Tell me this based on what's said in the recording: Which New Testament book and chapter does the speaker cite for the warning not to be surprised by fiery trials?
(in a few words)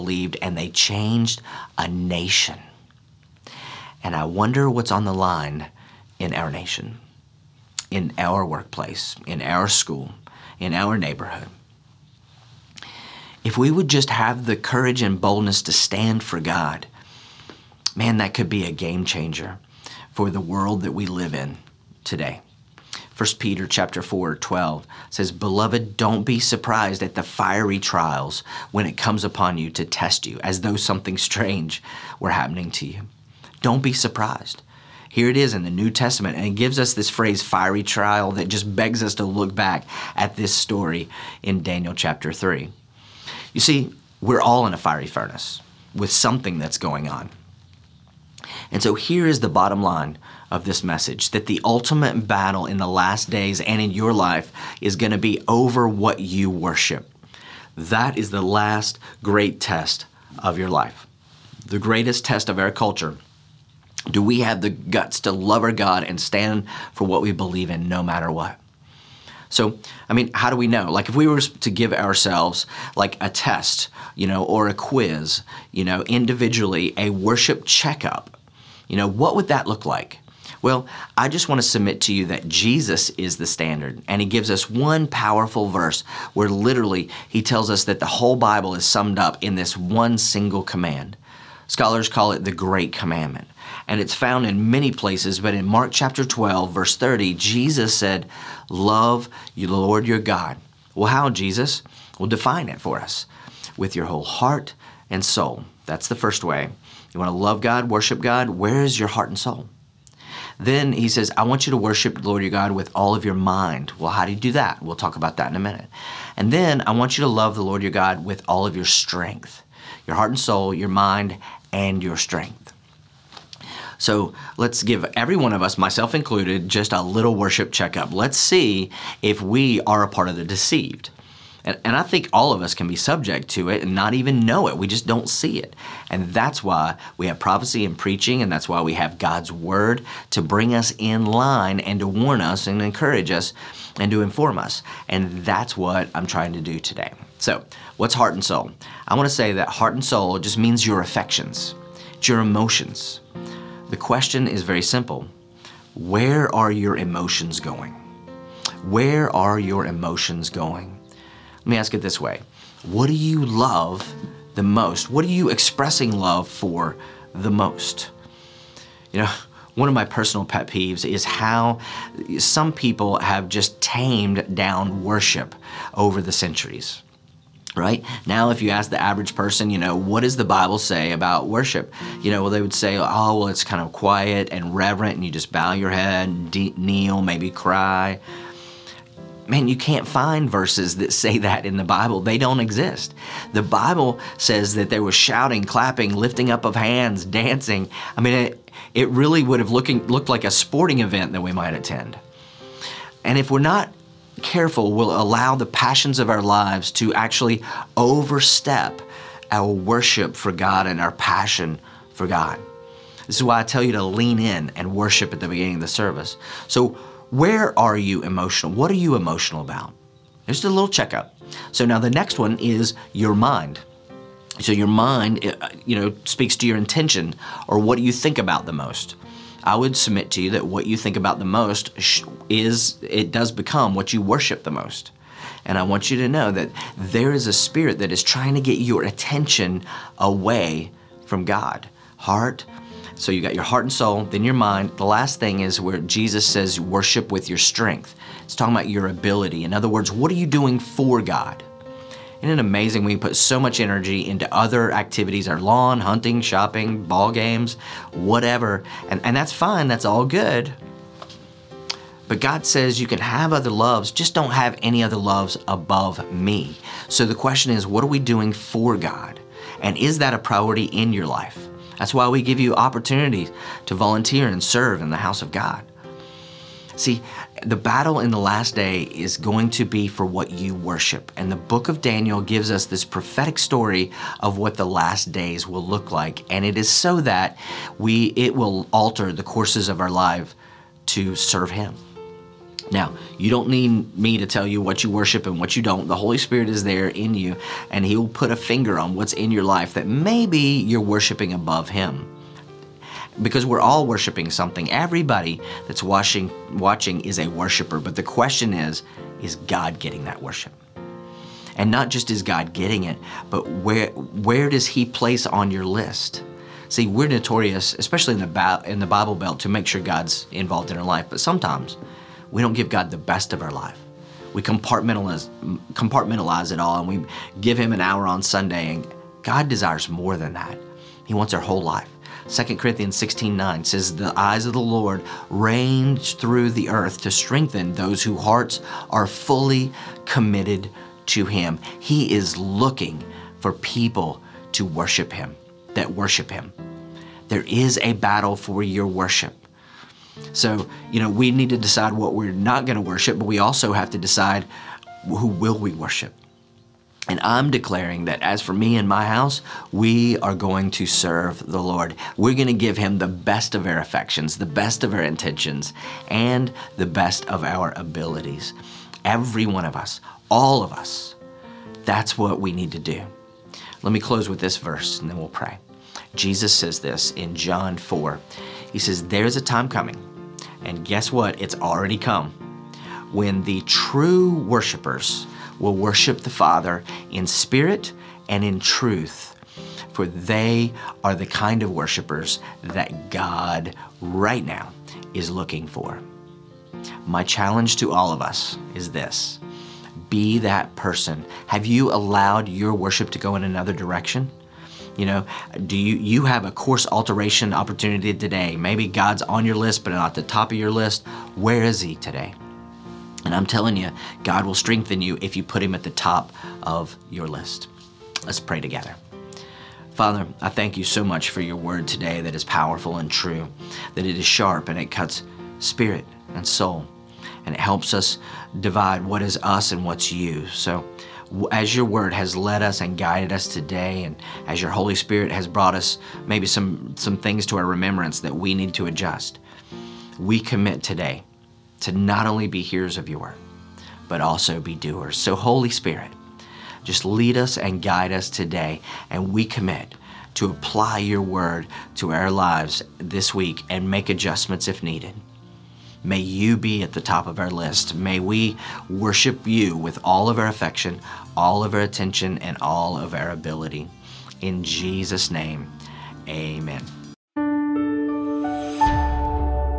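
1 Peter chapter 4.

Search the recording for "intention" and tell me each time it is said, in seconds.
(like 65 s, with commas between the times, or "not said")
226 s, 365 s.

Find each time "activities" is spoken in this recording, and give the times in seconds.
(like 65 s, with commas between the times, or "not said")
254 s.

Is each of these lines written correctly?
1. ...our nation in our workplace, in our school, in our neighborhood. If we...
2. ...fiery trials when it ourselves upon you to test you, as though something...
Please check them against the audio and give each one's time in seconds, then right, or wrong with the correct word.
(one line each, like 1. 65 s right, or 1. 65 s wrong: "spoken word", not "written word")
1. 6 s right
2. 27 s wrong: "comes", not "ourselves".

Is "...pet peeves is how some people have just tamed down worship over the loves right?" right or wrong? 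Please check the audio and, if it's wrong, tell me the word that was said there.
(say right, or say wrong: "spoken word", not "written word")
wrong: "centuries", not "loves".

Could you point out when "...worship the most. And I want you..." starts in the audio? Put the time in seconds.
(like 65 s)
234 s.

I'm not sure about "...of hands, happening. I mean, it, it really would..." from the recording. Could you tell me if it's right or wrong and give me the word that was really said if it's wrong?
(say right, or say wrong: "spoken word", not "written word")
wrong: "dancing", not "happening".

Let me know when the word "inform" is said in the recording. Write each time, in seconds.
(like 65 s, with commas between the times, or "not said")
144 s.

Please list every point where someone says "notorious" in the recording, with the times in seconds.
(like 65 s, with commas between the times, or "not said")
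317 s.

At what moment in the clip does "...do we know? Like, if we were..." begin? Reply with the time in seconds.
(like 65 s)
70 s.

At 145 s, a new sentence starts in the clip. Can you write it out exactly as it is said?
And that's what I'm trying to do today.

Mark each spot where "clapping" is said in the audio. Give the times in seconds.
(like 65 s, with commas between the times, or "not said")
195 s.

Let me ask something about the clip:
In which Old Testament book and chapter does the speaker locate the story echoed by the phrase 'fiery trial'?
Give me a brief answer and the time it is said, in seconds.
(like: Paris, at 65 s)
Daniel chapter 3, at 41 s.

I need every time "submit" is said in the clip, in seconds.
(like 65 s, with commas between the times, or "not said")
81 s, 229 s.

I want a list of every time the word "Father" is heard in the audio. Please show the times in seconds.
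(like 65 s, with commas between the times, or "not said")
386 s, 420 s.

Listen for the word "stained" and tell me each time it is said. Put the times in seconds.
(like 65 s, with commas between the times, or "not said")
not said.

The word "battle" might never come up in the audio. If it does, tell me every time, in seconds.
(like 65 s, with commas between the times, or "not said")
52 s, 277 s, 348 s.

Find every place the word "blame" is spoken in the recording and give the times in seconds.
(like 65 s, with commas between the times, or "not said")
not said.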